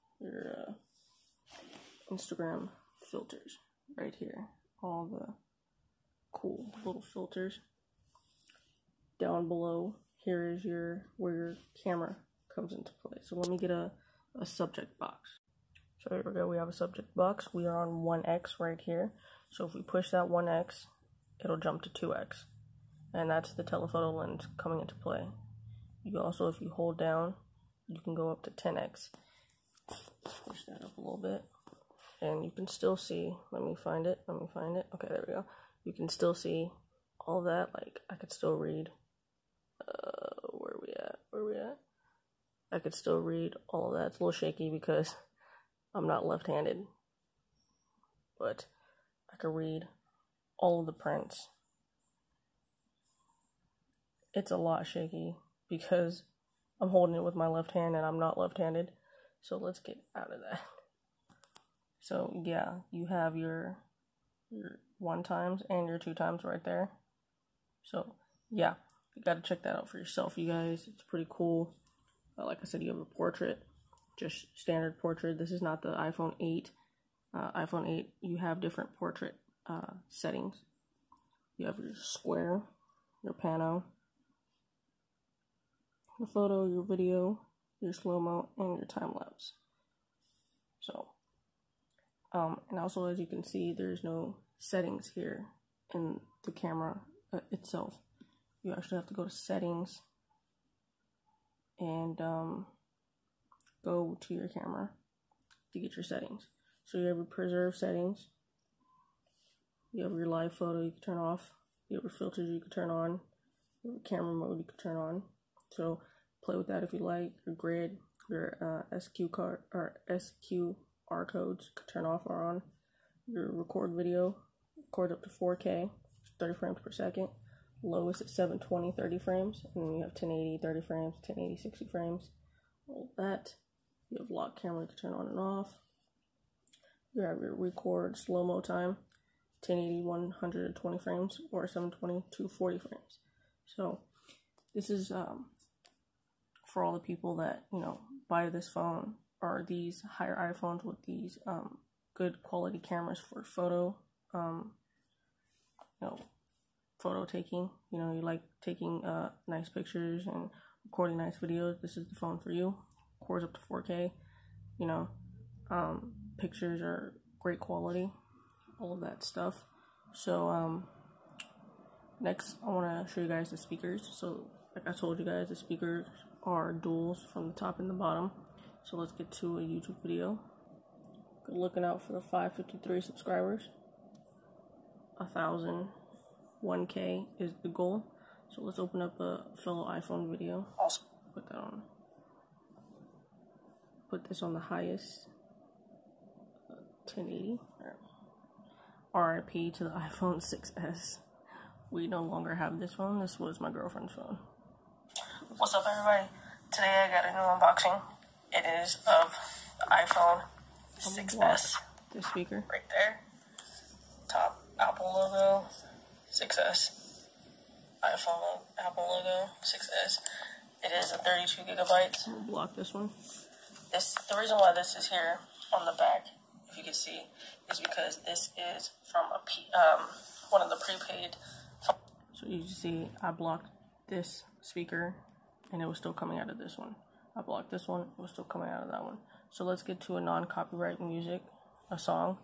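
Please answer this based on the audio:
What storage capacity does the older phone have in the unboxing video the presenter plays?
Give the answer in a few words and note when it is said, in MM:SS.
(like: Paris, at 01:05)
32 gigabytes, at 03:41.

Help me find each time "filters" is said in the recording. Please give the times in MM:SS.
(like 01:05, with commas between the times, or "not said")
00:03, 00:07, 01:52.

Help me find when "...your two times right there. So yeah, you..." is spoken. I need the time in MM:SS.
01:05.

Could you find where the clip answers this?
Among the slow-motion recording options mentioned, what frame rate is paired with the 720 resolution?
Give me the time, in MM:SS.
02:22.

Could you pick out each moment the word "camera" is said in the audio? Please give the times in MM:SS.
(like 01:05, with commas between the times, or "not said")
00:11, 01:36, 01:44, 01:54, 02:14, 02:32.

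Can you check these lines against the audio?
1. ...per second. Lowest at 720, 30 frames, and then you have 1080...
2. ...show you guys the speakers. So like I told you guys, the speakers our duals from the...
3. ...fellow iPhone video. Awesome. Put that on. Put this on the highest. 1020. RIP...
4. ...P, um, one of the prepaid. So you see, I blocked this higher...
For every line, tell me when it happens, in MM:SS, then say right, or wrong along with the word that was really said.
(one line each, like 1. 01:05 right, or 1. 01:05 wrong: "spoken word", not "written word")
1. 02:06 right
2. 02:53 right
3. 03:09 wrong: "1080", not "1020"
4. 03:49 wrong: "speaker", not "higher".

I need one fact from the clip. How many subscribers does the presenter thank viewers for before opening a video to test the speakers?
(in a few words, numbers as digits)
553.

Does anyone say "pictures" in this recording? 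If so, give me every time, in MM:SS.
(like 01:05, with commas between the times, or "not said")
02:39, 02:46.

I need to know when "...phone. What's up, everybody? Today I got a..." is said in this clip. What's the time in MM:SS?
03:24.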